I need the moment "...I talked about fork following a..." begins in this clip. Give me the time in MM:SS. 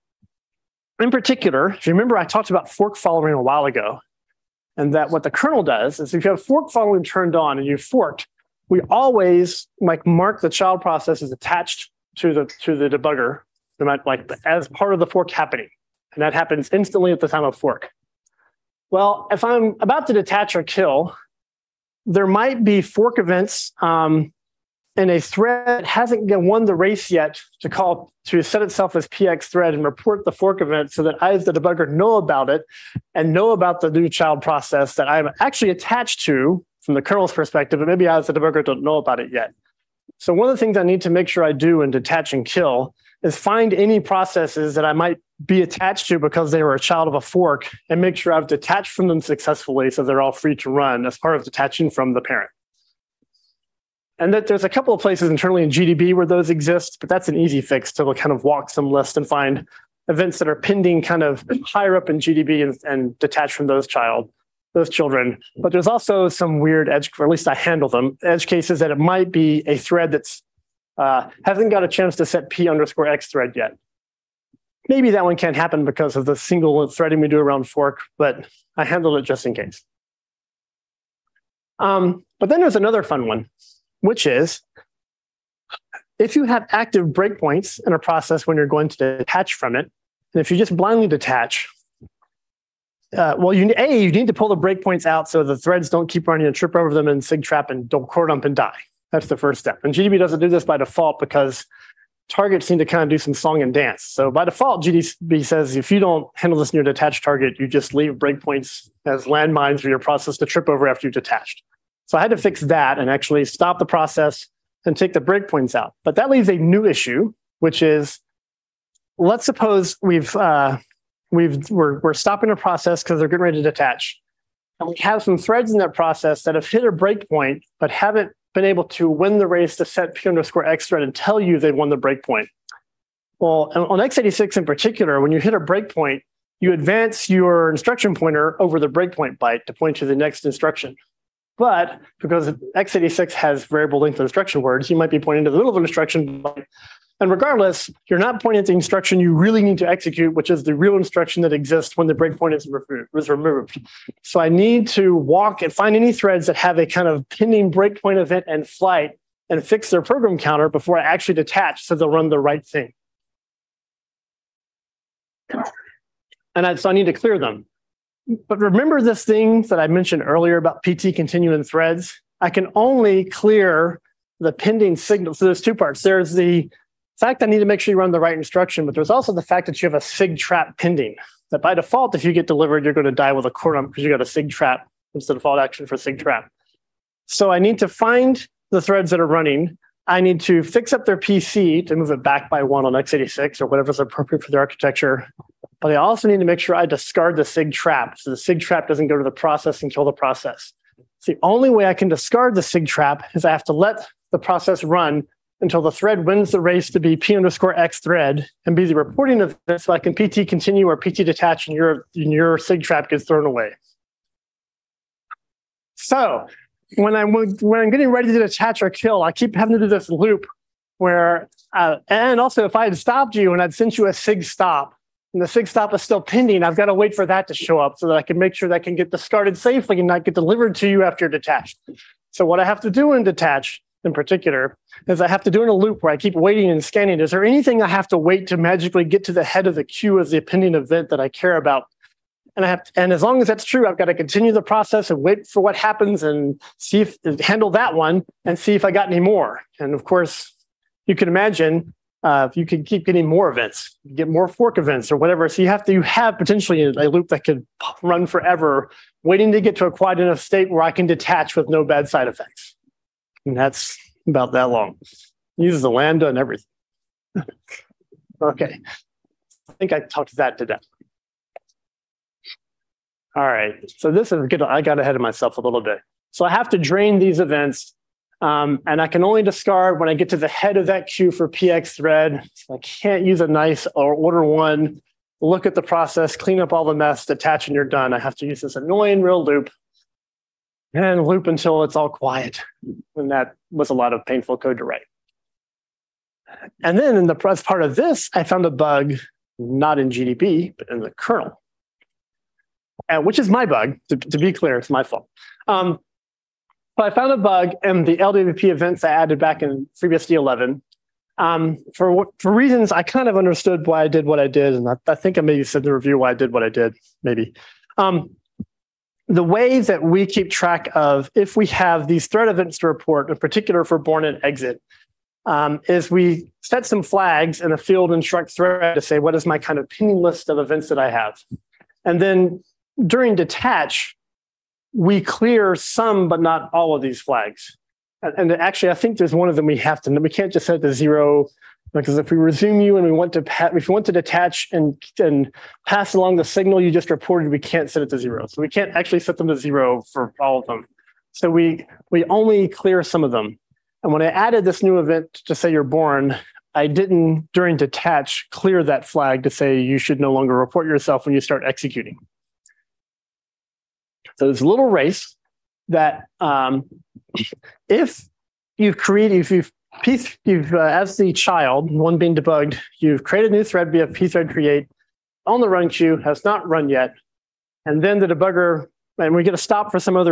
00:02.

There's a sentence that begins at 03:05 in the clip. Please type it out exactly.
It's the default action for SIG trap.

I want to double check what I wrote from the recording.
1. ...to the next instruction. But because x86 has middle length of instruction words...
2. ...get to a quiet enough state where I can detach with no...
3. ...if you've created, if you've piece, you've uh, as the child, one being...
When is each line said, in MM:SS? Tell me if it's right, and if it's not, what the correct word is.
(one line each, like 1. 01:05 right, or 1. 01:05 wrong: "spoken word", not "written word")
1. 02:19 wrong: "variable", not "middle"
2. 04:19 right
3. 06:07 right.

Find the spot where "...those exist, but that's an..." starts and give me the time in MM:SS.
00:56.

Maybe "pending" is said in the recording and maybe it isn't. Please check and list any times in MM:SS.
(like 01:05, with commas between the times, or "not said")
01:00, 02:37, 02:54, 03:00, 03:46, 04:00, 05:29.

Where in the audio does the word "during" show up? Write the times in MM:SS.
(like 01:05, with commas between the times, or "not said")
05:33, 05:57.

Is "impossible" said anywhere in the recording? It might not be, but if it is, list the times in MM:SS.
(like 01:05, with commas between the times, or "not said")
not said.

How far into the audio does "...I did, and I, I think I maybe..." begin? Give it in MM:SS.
05:14.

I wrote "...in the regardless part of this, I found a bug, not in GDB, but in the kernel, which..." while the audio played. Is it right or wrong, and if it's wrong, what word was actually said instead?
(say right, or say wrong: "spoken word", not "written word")
wrong: "press", not "regardless".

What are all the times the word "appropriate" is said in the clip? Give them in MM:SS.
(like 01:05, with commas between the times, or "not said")
03:13.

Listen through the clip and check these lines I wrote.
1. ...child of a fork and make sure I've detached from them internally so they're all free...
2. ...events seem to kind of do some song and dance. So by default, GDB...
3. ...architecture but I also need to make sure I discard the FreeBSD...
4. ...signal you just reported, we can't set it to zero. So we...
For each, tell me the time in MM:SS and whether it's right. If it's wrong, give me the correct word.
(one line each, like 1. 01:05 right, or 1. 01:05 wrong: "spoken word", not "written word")
1. 00:46 wrong: "successfully", not "internally"
2. 01:42 wrong: "targets", not "events"
3. 03:14 wrong: "SIG", not "FreeBSD"
4. 05:46 right.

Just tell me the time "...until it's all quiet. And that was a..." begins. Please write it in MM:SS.
04:51.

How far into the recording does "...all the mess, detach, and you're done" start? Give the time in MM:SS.
04:46.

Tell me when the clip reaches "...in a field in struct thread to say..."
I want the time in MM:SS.
05:27.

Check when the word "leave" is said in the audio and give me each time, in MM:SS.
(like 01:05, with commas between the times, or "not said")
01:47, 01:56.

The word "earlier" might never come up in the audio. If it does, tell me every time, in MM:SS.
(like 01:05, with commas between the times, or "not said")
02:50.